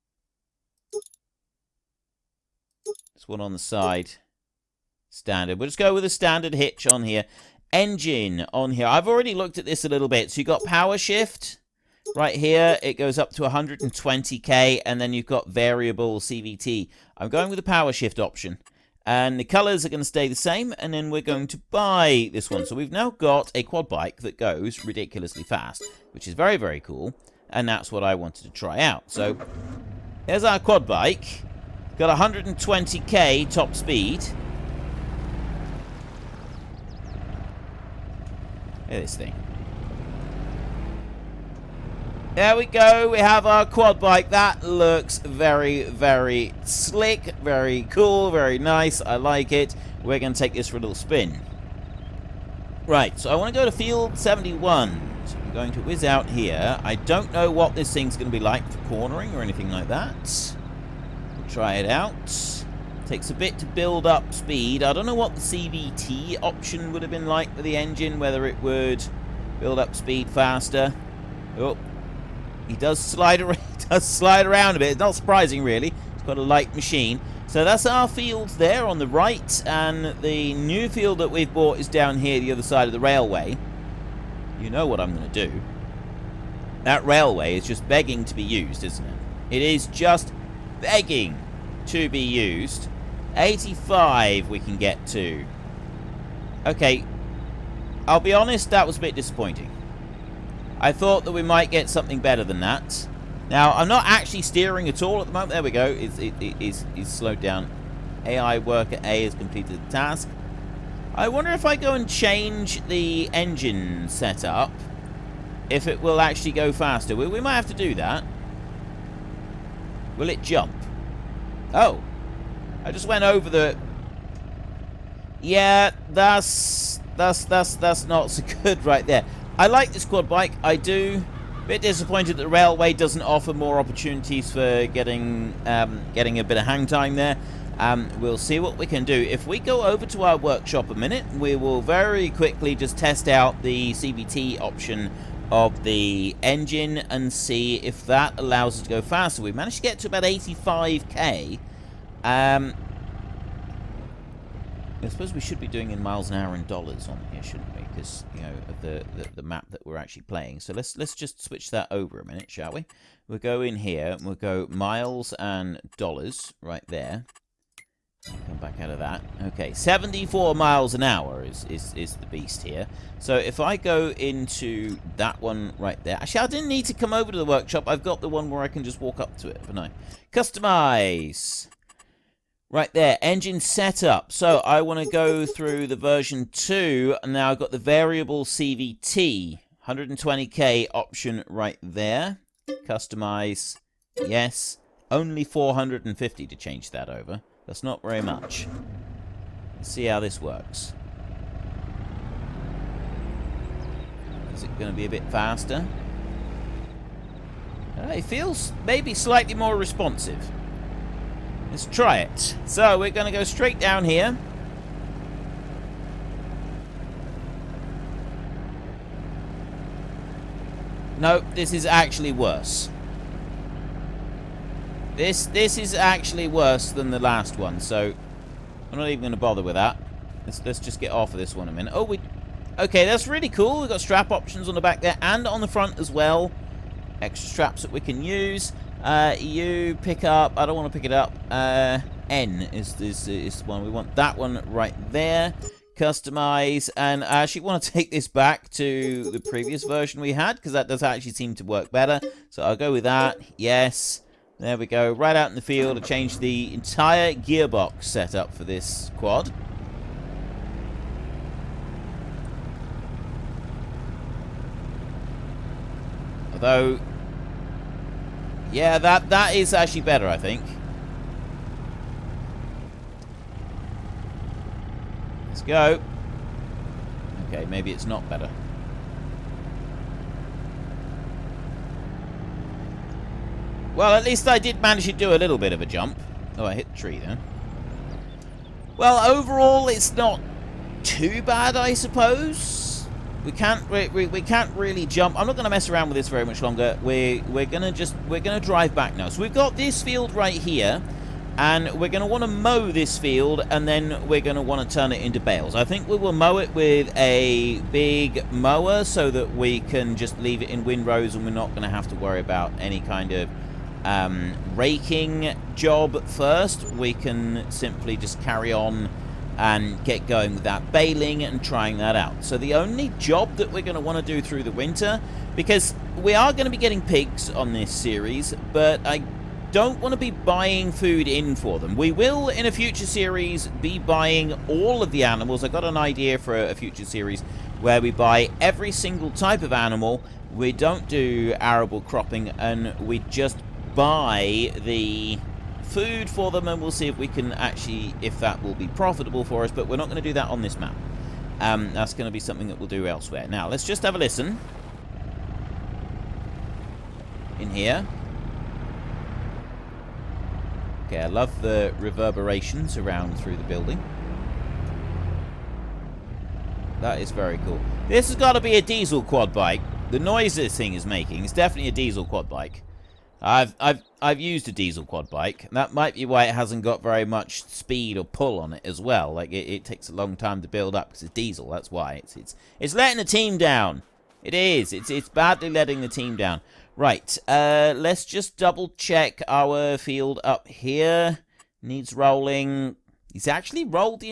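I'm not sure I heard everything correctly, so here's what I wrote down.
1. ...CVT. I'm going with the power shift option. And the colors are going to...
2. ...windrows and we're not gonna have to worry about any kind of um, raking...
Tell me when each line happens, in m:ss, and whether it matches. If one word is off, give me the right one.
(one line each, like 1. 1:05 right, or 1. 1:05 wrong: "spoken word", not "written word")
1. 0:16 right
2. 5:10 right.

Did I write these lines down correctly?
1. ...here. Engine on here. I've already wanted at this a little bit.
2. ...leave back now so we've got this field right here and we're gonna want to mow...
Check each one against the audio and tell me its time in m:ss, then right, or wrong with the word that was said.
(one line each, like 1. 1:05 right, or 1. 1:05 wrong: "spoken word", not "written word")
1. 0:07 wrong: "looked", not "wanted"
2. 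4:58 wrong: "drive", not "leave".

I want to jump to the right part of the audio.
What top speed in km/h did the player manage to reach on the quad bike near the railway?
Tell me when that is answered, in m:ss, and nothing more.
1:33.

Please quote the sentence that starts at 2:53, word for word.
So if I go into that one right there...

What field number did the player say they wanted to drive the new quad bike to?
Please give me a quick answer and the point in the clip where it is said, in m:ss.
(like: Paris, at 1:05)
71, at 0:53.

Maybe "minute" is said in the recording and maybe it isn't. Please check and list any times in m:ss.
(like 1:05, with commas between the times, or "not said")
2:20, 2:42, 3:51.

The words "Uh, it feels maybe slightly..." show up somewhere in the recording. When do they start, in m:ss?
3:27.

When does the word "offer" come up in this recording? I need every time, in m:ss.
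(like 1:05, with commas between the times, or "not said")
2:13.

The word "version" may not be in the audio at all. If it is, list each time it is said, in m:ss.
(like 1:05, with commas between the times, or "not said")
3:05, 4:09.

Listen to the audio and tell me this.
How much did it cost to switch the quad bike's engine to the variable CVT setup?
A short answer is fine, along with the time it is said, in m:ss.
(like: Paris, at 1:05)
450, at 3:15.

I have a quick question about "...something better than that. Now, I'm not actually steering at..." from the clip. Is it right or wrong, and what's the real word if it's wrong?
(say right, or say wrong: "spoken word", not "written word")
right.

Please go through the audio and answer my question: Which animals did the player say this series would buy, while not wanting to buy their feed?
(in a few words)
Pigs.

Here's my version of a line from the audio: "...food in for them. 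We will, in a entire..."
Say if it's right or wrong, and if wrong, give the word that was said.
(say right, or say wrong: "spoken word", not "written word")
wrong: "future", not "entire".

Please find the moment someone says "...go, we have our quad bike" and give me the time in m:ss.
0:42.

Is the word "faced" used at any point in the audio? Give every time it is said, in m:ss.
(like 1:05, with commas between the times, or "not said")
not said.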